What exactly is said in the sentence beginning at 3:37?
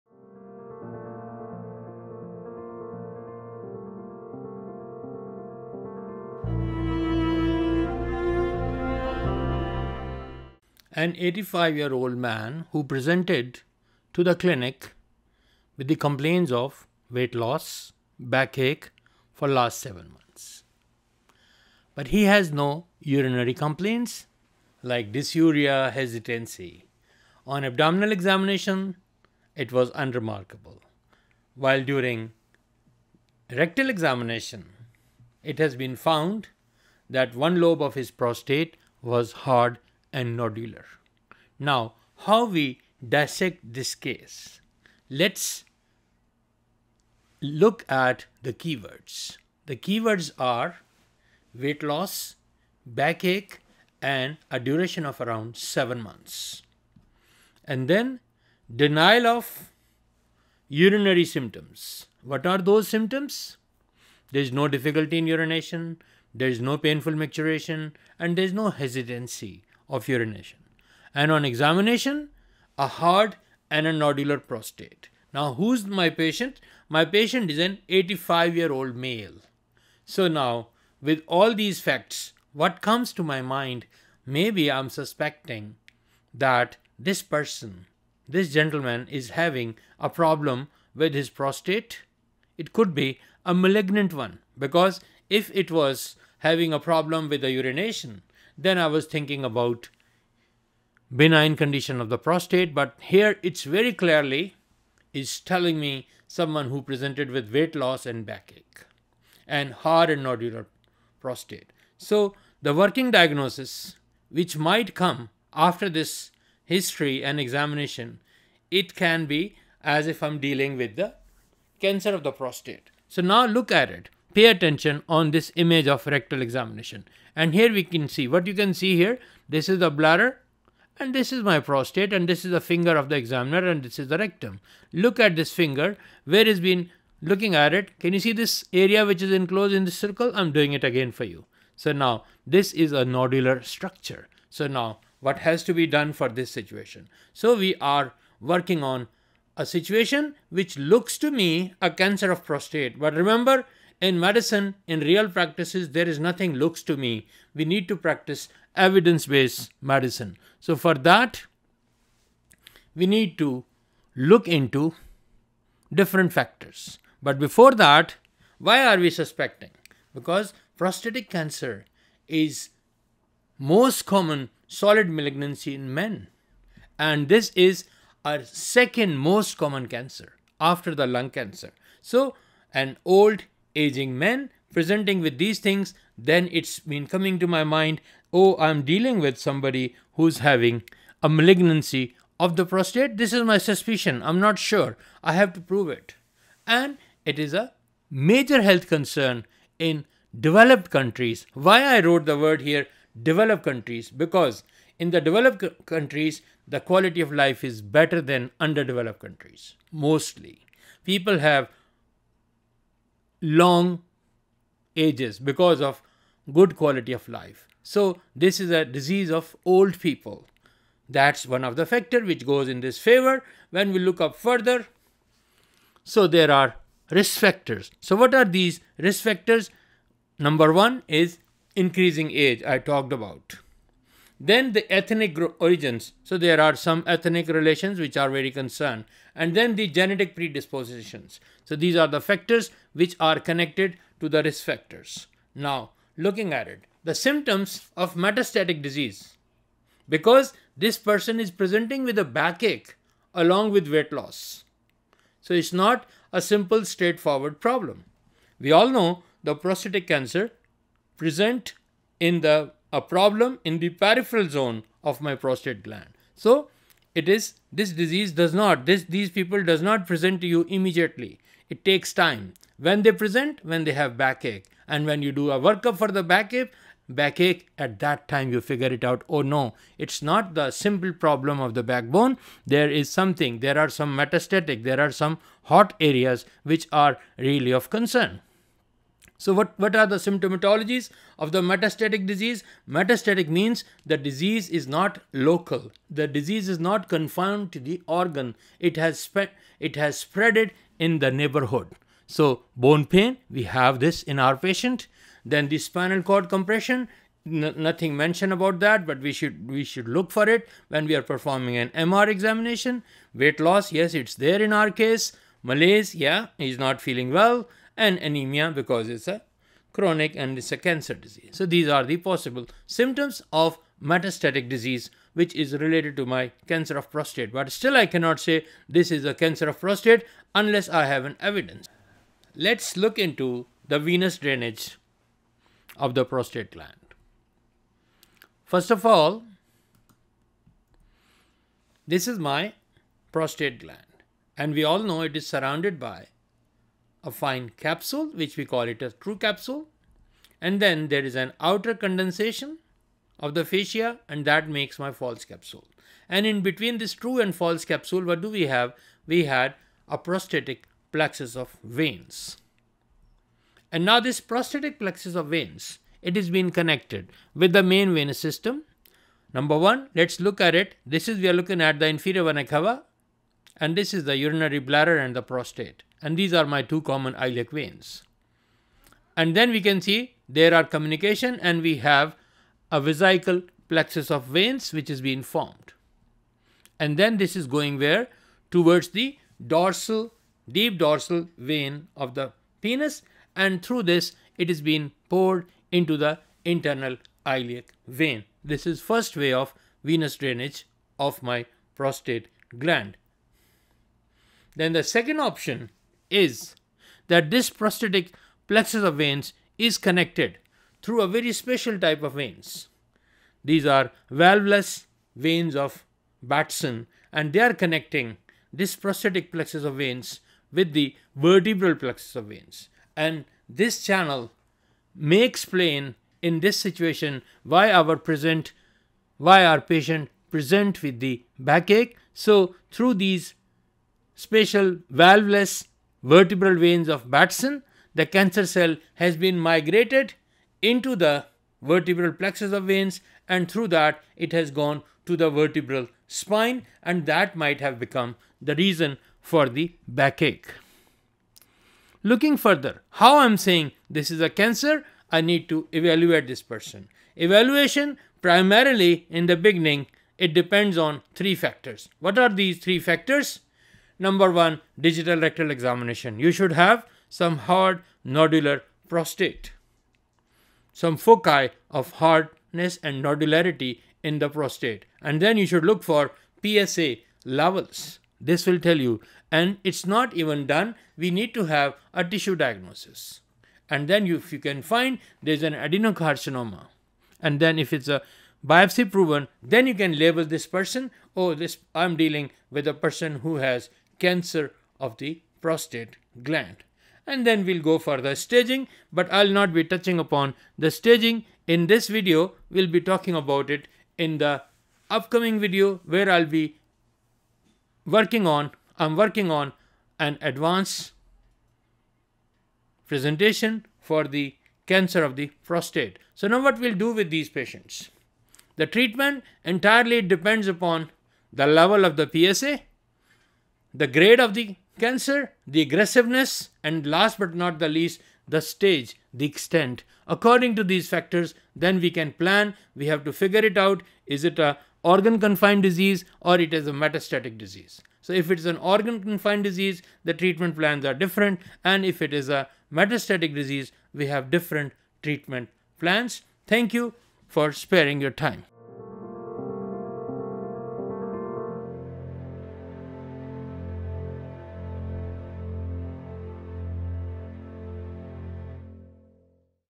So this is a disease of old people.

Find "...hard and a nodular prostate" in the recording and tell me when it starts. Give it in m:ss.
1:12.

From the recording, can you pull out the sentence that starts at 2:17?
Can you see this area which is enclosed in this circle?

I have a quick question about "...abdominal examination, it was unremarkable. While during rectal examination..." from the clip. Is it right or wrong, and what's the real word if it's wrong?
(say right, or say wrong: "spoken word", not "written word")
right.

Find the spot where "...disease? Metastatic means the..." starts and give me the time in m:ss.
4:52.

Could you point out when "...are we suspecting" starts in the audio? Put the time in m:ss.
2:48.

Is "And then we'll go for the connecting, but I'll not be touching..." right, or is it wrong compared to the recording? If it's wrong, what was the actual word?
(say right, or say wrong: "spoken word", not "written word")
wrong: "staging", not "connecting".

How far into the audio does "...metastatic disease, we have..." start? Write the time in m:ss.
9:02.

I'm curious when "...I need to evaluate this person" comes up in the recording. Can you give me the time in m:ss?
7:35.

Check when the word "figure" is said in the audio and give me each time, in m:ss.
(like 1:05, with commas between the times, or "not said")
4:38, 8:53.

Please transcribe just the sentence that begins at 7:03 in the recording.
And this channel may explain in this situation why our present why our patient present with the backache.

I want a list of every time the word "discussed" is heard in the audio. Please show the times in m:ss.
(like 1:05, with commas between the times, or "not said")
not said.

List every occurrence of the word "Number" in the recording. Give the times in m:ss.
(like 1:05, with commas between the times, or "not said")
3:50, 6:09, 7:44.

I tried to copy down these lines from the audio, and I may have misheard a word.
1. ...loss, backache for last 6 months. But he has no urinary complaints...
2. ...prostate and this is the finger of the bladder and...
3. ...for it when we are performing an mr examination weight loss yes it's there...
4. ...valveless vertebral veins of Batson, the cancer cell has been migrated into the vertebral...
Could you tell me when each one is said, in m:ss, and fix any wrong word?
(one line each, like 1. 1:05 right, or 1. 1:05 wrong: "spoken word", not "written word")
1. 0:17 wrong: "7", not "6"
2. 2:11 wrong: "examiner", not "bladder"
3. 5:10 right
4. 7:15 right.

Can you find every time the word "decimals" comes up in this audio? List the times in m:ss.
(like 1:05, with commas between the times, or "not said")
not said.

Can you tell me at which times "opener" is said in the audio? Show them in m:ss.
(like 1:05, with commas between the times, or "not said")
not said.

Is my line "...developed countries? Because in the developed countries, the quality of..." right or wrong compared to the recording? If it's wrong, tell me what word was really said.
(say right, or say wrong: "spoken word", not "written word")
right.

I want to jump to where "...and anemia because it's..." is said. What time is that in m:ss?
5:18.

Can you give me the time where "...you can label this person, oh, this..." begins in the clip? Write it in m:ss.
8:09.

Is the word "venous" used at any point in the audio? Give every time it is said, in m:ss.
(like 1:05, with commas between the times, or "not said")
5:33, 6:08, 6:40.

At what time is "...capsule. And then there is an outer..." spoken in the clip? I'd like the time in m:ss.
5:49.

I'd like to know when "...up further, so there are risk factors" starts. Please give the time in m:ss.
3:44.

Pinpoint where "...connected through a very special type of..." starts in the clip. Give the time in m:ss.
6:49.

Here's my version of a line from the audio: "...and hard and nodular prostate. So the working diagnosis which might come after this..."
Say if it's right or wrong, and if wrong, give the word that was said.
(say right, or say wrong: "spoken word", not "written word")
right.